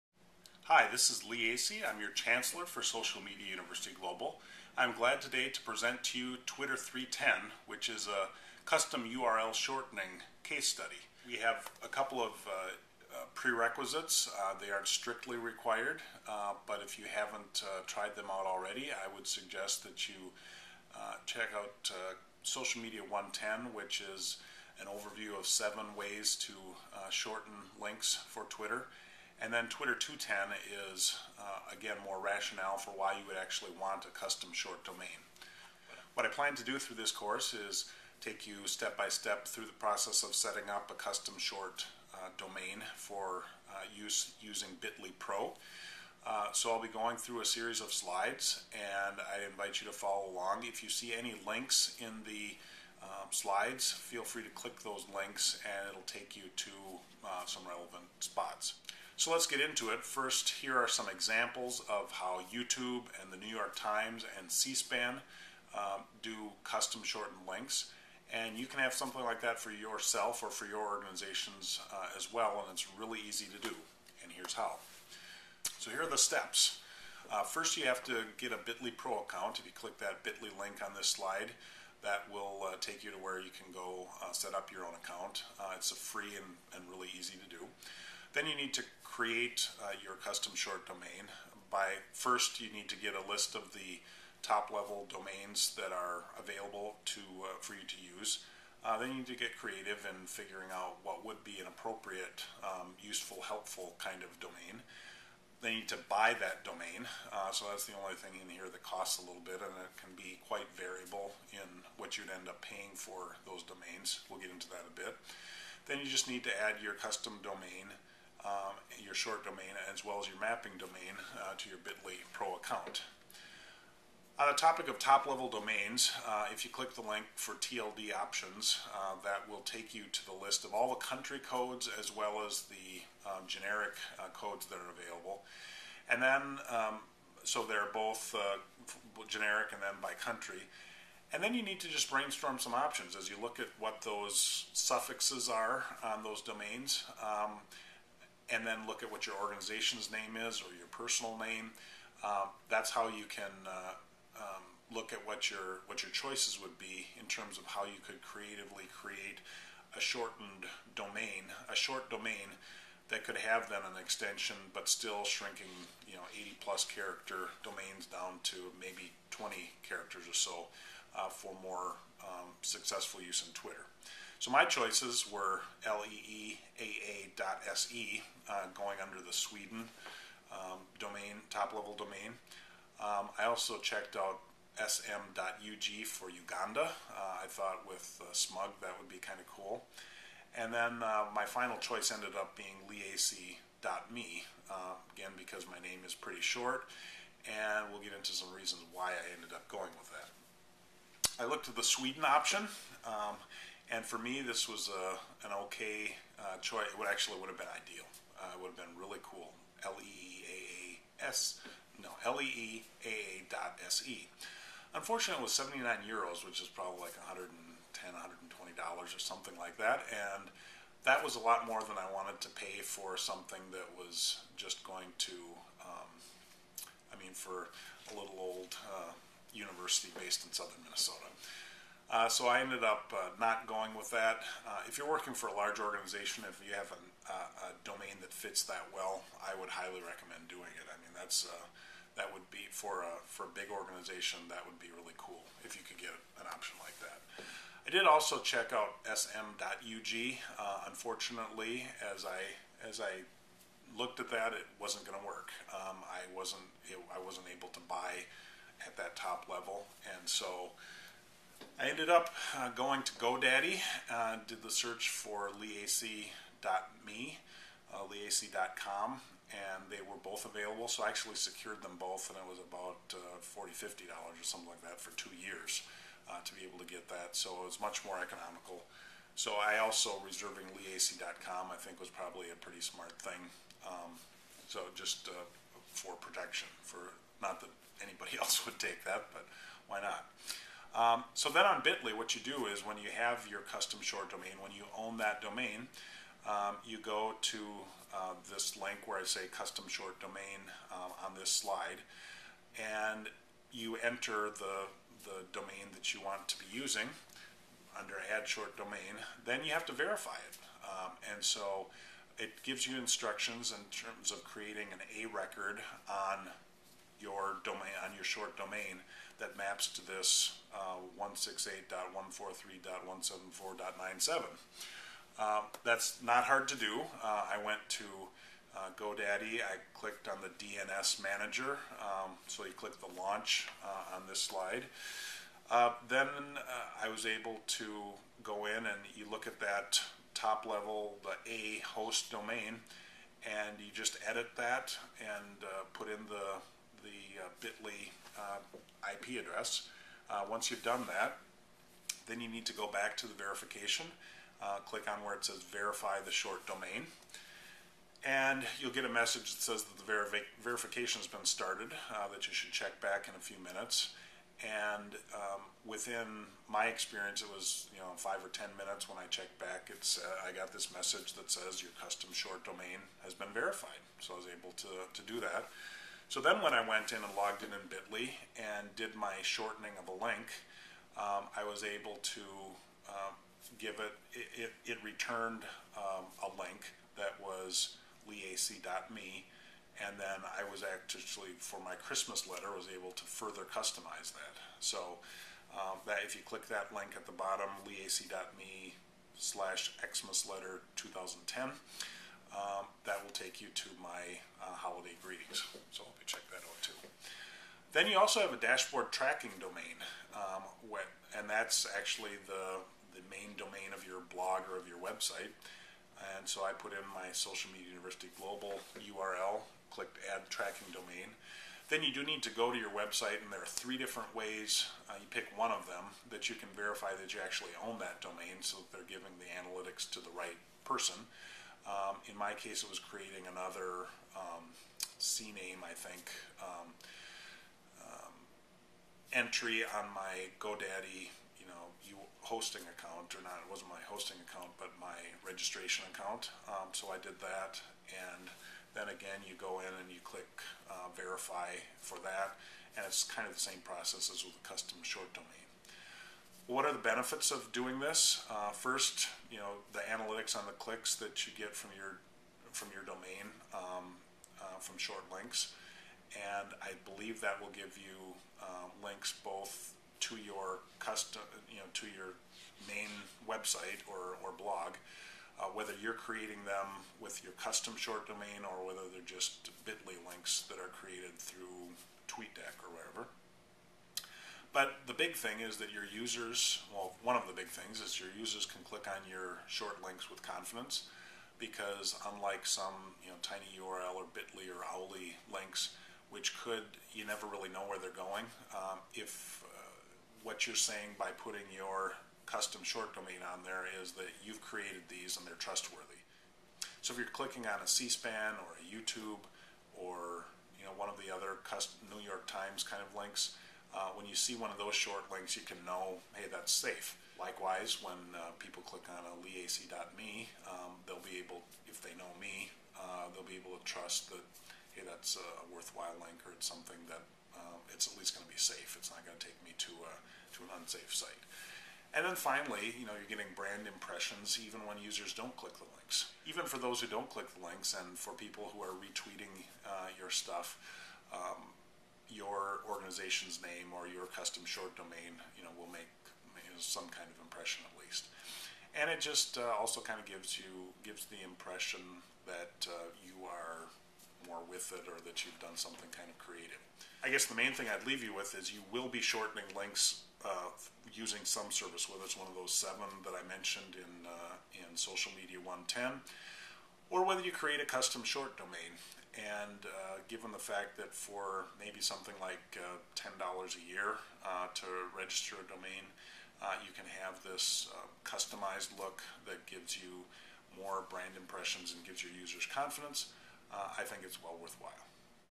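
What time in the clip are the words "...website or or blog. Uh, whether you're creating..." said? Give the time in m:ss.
7:53.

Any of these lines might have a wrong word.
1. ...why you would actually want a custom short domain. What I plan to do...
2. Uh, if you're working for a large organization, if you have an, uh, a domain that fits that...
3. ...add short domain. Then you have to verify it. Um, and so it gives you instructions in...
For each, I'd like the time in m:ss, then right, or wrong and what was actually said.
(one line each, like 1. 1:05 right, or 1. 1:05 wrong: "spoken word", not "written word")
1. 0:32 right
2. 3:54 right
3. 5:08 right.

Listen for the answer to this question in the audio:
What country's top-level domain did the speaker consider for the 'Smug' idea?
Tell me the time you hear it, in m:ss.
3:06.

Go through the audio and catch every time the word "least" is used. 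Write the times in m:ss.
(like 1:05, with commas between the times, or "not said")
8:48, 9:08.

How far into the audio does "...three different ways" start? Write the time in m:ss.
7:03.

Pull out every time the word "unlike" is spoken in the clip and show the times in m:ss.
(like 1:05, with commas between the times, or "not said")
8:12.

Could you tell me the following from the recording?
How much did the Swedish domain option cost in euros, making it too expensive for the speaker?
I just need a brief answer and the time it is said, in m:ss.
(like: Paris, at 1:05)
79 euros, at 3:35.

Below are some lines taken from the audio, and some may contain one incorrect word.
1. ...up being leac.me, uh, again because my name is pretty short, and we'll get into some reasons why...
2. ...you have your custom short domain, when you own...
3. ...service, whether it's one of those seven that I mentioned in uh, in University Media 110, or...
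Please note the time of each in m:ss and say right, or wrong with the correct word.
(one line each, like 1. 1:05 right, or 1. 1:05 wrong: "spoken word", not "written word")
1. 3:12 right
2. 4:52 right
3. 9:21 wrong: "Social", not "University".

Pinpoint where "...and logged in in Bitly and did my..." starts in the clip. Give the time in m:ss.
6:17.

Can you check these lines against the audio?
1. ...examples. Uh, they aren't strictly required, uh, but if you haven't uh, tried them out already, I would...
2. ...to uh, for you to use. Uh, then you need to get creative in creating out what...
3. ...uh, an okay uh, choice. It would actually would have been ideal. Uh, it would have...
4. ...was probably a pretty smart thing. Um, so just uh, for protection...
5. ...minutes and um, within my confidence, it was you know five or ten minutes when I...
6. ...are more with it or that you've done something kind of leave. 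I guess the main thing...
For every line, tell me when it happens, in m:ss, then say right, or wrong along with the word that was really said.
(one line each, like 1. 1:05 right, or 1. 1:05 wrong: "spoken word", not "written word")
1. 0:13 wrong: "prerequisites", not "examples"
2. 1:37 wrong: "figuring", not "creating"
3. 3:25 right
4. 4:41 right
5. 6:03 wrong: "experience", not "confidence"
6. 9:13 wrong: "creative", not "leave".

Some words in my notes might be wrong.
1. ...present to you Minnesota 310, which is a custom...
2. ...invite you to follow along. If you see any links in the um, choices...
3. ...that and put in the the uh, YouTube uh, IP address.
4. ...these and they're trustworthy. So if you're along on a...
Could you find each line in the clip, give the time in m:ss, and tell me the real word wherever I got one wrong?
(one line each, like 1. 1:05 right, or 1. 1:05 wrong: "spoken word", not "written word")
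1. 0:05 wrong: "Twitter", not "Minnesota"
2. 0:49 wrong: "slides", not "choices"
3. 5:44 wrong: "Bitly", not "YouTube"
4. 8:25 wrong: "clicking", not "along".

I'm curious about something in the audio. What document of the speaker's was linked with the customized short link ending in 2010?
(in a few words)
Christmas letter.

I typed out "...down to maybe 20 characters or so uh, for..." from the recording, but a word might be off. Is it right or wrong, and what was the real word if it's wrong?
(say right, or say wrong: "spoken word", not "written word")
right.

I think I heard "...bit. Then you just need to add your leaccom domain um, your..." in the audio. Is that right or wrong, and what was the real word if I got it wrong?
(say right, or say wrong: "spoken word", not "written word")
wrong: "custom", not "leaccom".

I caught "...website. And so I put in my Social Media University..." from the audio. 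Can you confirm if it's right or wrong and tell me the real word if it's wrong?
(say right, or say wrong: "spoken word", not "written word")
right.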